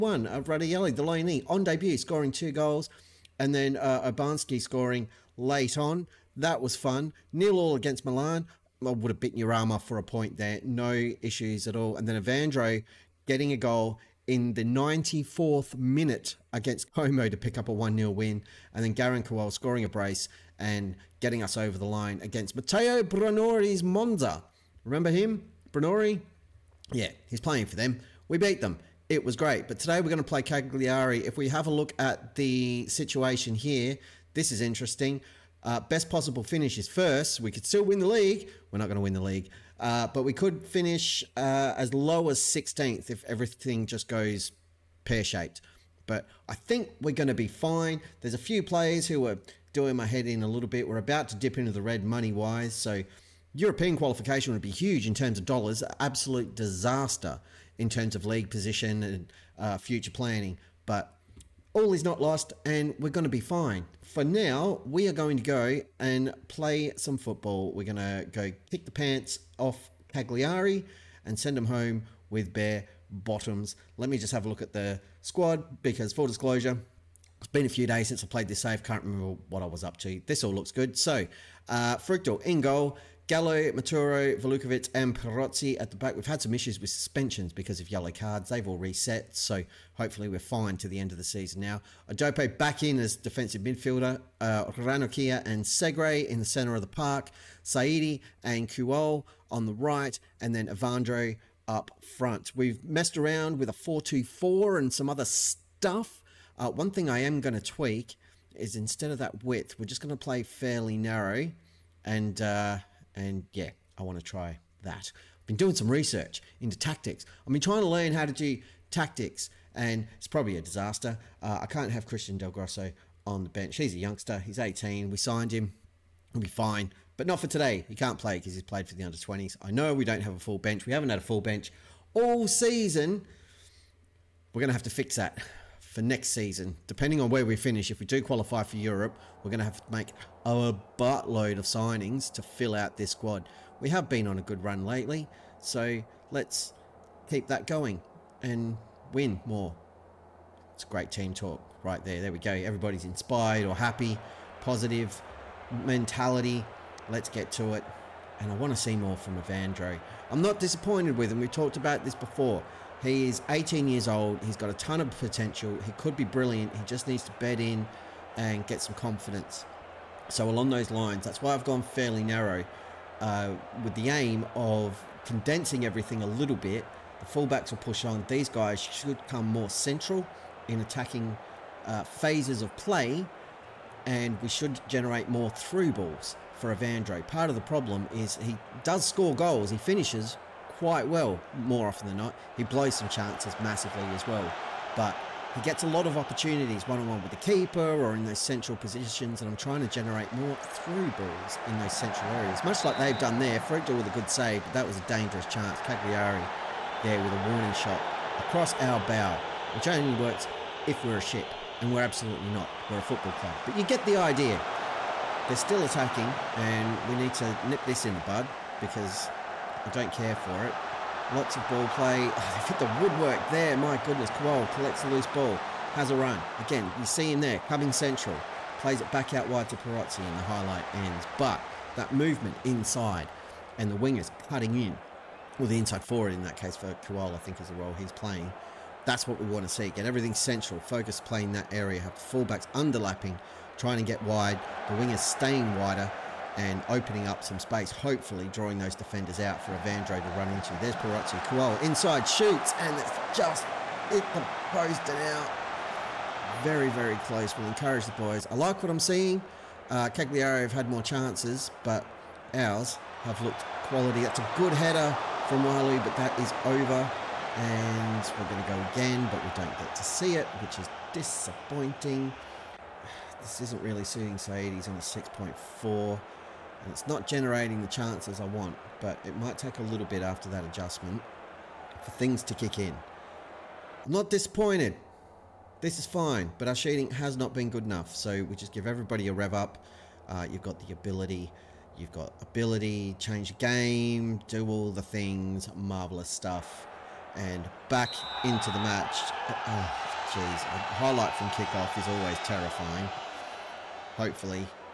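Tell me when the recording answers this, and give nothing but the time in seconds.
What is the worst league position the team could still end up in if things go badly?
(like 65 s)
42 s.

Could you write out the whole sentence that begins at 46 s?
But I think we're going to be fine.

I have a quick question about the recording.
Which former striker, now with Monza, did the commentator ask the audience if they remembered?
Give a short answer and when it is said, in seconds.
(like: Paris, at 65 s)
Matteo Brunori, at 22 s.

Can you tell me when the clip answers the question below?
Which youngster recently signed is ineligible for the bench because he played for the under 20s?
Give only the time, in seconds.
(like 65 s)
122 s.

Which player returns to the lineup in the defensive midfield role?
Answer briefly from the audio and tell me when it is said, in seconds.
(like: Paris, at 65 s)
Adope, at 92 s.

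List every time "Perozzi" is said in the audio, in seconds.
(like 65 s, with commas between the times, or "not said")
85 s, 229 s.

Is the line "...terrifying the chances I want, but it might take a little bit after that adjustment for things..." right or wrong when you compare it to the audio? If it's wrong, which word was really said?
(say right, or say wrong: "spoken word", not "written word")
wrong: "generating", not "terrifying".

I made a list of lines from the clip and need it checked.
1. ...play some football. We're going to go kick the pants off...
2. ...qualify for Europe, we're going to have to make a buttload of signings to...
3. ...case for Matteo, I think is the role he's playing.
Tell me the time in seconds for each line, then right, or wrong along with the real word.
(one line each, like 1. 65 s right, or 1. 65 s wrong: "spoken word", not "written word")
1. 66 s right
2. 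138 s right
3. 236 s wrong: "Kuol", not "Matteo".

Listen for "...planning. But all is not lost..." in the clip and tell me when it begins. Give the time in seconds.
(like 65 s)
60 s.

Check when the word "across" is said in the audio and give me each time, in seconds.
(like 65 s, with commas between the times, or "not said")
208 s.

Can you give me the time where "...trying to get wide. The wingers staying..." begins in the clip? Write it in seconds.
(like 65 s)
243 s.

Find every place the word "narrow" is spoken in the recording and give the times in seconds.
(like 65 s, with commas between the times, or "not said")
110 s, 172 s.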